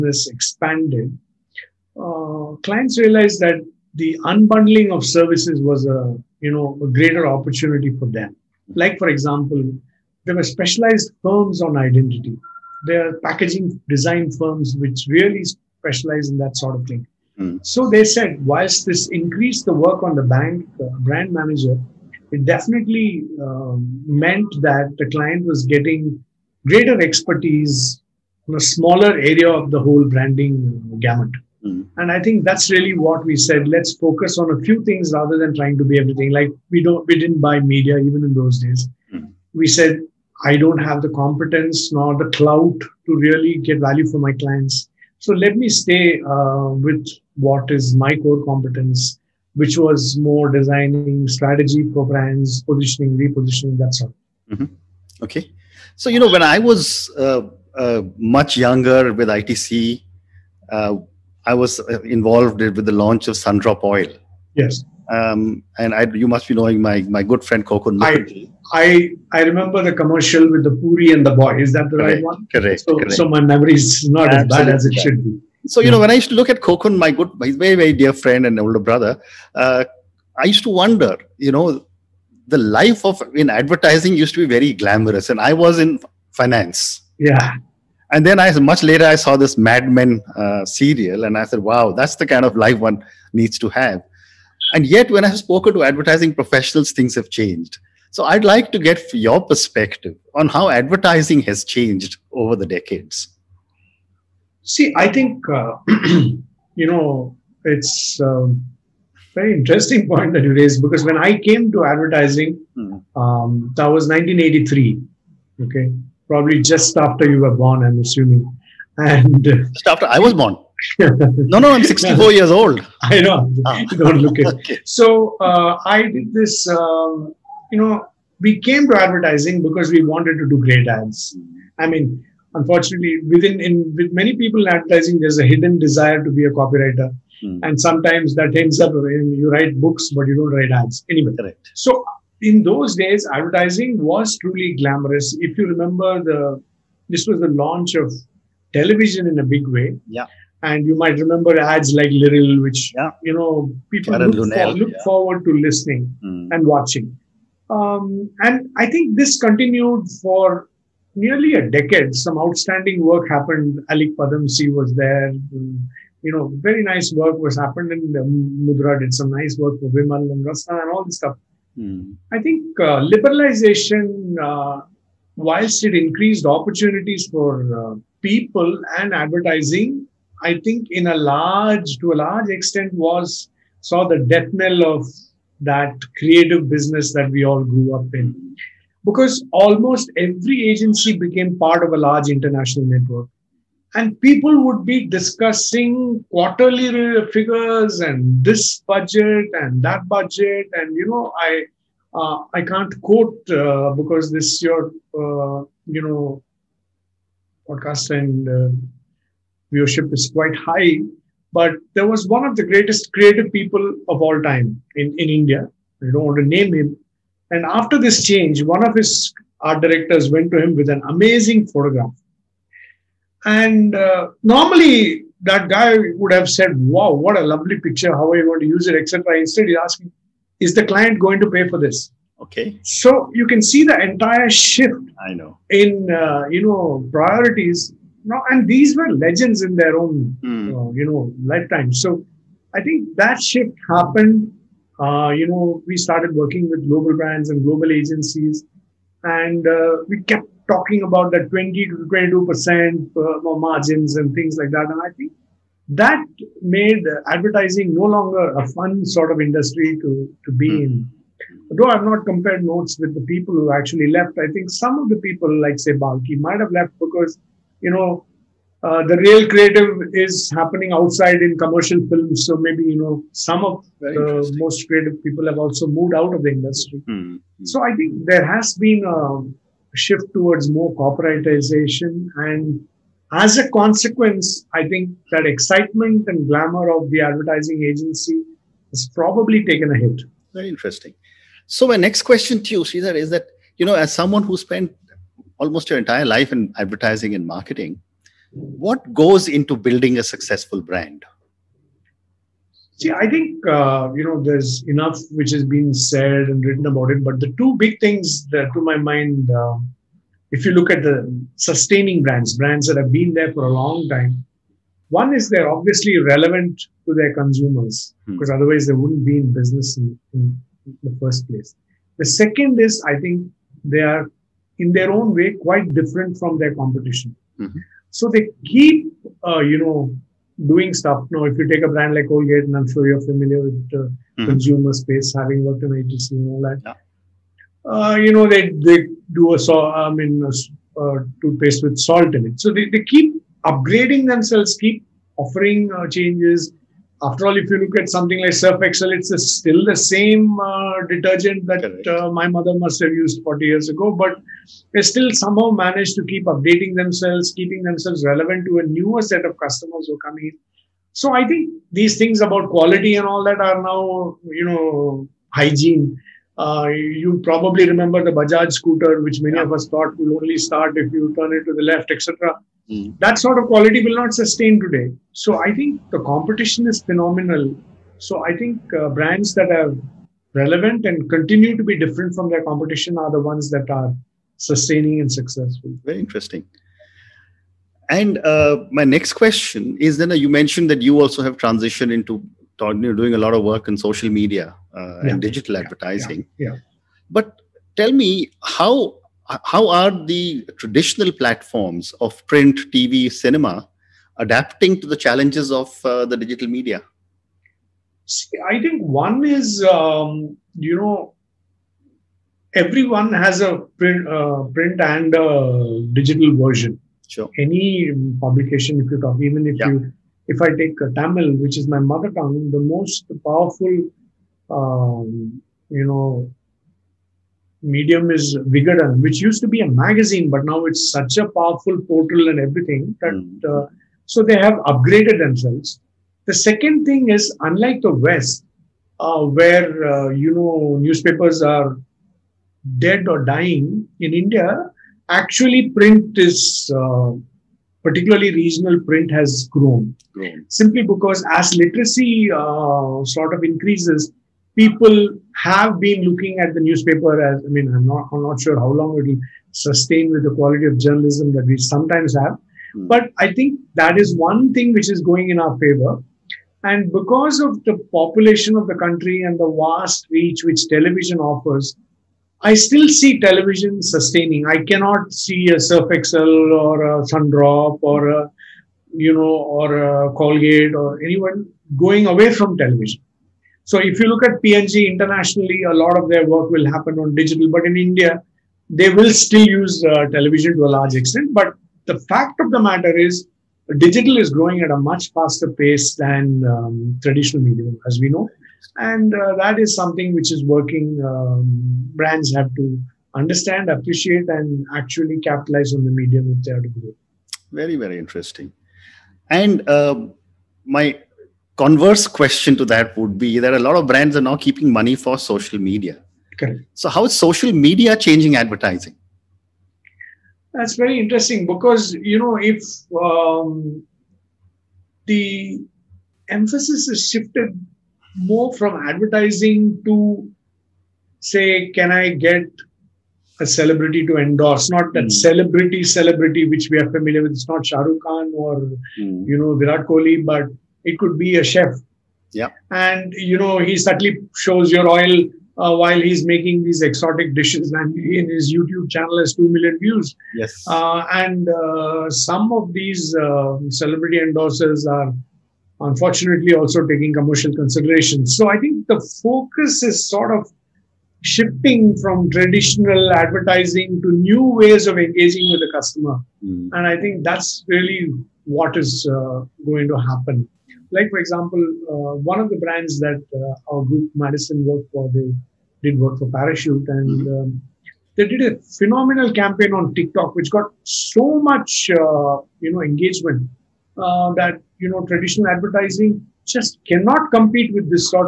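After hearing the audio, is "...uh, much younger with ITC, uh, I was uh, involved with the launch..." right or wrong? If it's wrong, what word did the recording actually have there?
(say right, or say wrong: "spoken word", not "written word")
right.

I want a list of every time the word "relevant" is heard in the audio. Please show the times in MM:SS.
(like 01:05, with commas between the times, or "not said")
05:16, 05:58, 06:20.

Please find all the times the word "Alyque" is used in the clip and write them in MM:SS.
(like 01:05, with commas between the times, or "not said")
02:43.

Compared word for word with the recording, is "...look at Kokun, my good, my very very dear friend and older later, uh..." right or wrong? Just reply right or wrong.
wrong.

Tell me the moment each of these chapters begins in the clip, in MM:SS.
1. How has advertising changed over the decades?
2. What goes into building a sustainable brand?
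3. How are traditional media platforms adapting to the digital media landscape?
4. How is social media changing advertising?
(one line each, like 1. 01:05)
1. 00:57
2. 04:56
3. 06:28
4. 08:29.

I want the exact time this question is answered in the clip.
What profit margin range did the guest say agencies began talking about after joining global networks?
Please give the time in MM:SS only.
04:11.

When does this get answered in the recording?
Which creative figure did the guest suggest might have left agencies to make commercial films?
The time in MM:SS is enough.
04:25.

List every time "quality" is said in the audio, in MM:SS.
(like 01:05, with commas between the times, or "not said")
06:02, 06:13, 07:40.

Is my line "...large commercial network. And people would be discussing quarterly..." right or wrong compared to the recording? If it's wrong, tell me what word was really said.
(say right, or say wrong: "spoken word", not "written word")
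wrong: "international", not "commercial".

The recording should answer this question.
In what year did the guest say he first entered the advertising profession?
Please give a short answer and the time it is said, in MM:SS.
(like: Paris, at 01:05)
1983, at 01:54.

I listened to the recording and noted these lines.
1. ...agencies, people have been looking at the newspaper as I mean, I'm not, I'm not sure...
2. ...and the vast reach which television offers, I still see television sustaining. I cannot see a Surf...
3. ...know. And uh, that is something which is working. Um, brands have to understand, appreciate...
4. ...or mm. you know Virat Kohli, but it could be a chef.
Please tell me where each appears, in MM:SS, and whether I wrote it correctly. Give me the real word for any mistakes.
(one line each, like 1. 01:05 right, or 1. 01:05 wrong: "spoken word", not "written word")
1. 07:33 wrong: "increases", not "agencies"
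2. 07:49 right
3. 08:18 right
4. 08:58 right.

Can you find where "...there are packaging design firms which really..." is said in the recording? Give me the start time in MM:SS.
00:12.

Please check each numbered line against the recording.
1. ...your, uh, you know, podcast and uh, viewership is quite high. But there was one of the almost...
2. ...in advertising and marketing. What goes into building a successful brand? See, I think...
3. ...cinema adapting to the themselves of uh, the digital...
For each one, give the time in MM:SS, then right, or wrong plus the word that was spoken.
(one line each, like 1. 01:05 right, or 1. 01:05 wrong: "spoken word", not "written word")
1. 03:24 wrong: "greatest", not "almost"
2. 04:56 right
3. 06:43 wrong: "challenges", not "themselves".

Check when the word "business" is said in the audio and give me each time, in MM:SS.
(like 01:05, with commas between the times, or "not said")
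03:06, 05:19.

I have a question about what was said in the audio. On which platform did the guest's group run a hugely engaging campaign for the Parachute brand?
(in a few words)
TikTok.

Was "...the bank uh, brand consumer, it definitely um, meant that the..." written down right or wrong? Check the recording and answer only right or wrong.
wrong.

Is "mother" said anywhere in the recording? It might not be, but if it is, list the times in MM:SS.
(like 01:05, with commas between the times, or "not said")
05:52, 07:01.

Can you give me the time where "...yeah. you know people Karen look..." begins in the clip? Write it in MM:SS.
02:32.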